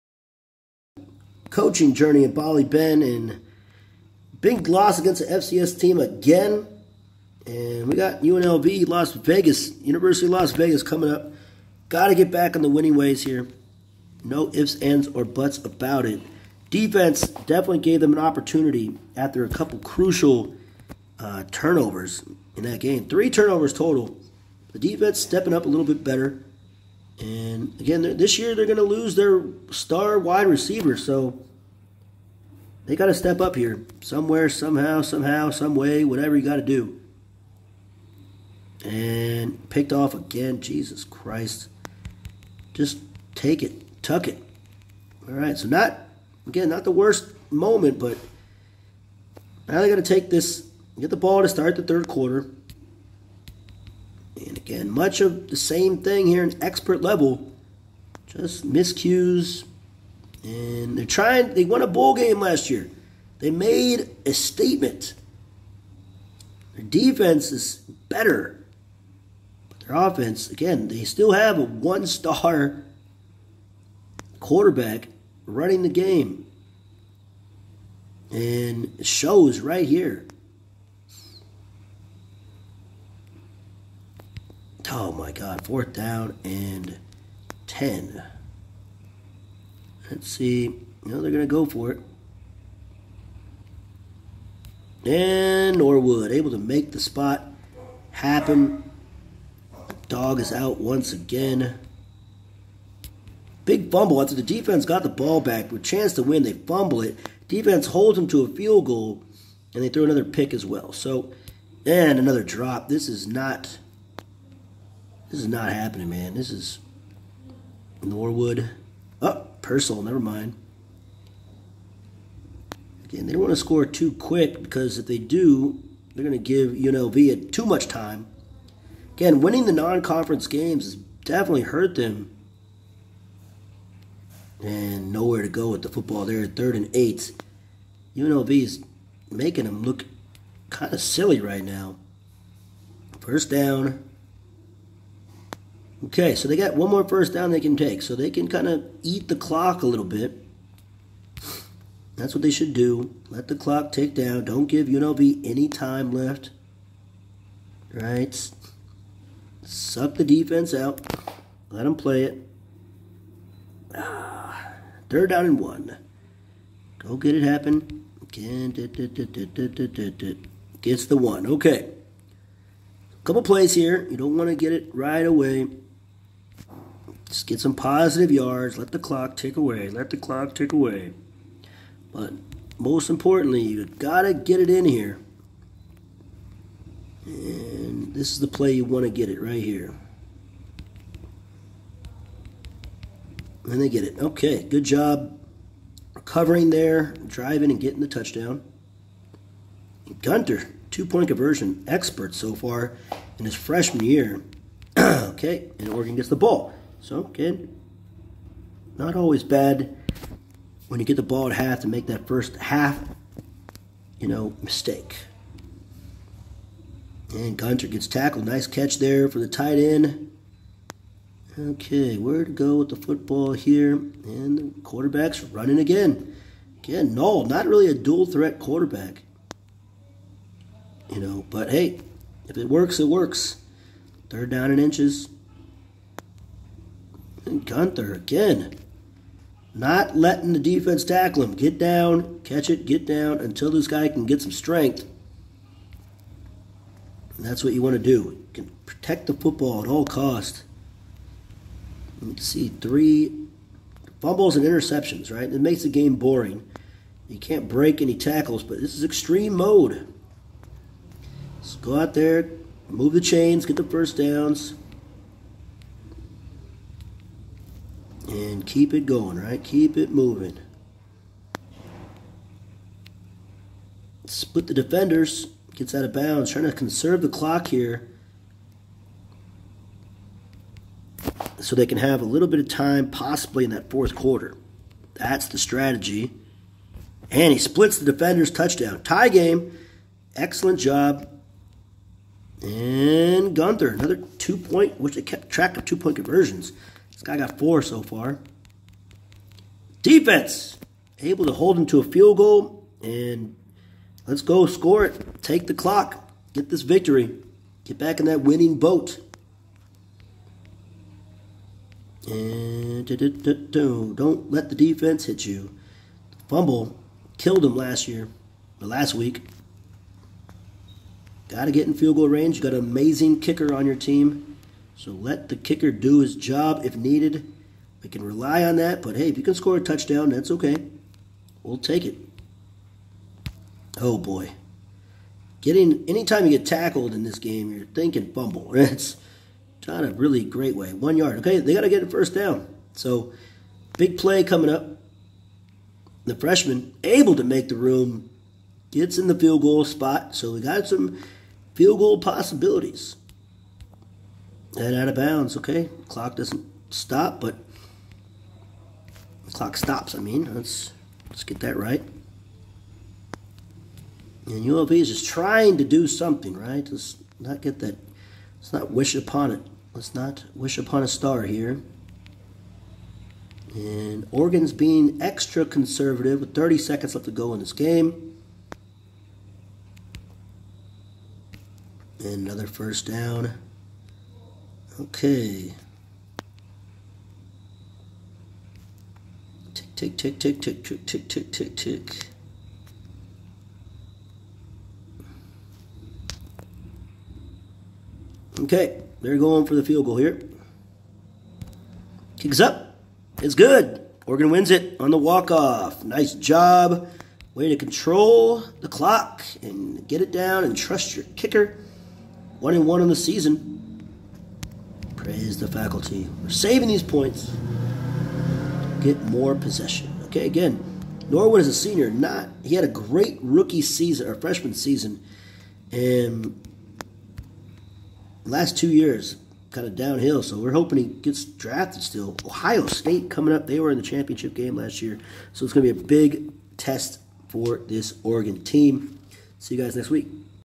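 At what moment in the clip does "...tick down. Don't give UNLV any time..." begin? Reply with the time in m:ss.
2:33.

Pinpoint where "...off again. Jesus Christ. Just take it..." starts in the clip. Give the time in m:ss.
0:39.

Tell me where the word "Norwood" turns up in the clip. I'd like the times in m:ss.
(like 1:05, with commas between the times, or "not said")
1:35, 1:58, 7:01.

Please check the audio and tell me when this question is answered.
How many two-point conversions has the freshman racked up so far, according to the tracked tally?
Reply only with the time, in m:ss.
4:57.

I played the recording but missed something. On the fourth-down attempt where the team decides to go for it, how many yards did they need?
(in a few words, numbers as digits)
10.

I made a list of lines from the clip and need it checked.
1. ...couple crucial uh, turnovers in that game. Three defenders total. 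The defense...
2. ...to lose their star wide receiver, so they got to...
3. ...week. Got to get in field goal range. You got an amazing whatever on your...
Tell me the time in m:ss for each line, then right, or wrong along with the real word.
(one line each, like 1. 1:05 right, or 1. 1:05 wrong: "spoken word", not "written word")
1. 0:19 wrong: "turnovers", not "defenders"
2. 0:28 right
3. 5:19 wrong: "kicker", not "whatever".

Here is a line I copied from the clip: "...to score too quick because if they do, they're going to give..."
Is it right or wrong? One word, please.
right.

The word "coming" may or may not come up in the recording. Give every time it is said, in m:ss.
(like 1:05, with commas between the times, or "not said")
0:10, 5:44, 7:13.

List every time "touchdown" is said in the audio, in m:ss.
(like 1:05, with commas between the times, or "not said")
3:18, 4:48, 5:29.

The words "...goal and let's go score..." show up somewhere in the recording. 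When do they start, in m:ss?
5:02.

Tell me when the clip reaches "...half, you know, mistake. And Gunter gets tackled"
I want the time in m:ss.
3:32.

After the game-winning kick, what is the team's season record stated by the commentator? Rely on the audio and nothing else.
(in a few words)
1-1.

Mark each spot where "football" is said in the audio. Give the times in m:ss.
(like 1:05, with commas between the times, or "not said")
2:15, 3:42, 4:09.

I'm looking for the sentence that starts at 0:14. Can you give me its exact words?
No ifs, ands, or buts about it.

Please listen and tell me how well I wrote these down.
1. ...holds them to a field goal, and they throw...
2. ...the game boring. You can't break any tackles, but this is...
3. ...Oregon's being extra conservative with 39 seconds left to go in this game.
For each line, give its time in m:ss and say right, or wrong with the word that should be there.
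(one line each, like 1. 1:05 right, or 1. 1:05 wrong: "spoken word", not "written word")
1. 1:47 right
2. 4:15 right
3. 6:14 wrong: "30", not "39".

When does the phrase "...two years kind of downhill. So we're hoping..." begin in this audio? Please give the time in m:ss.
7:08.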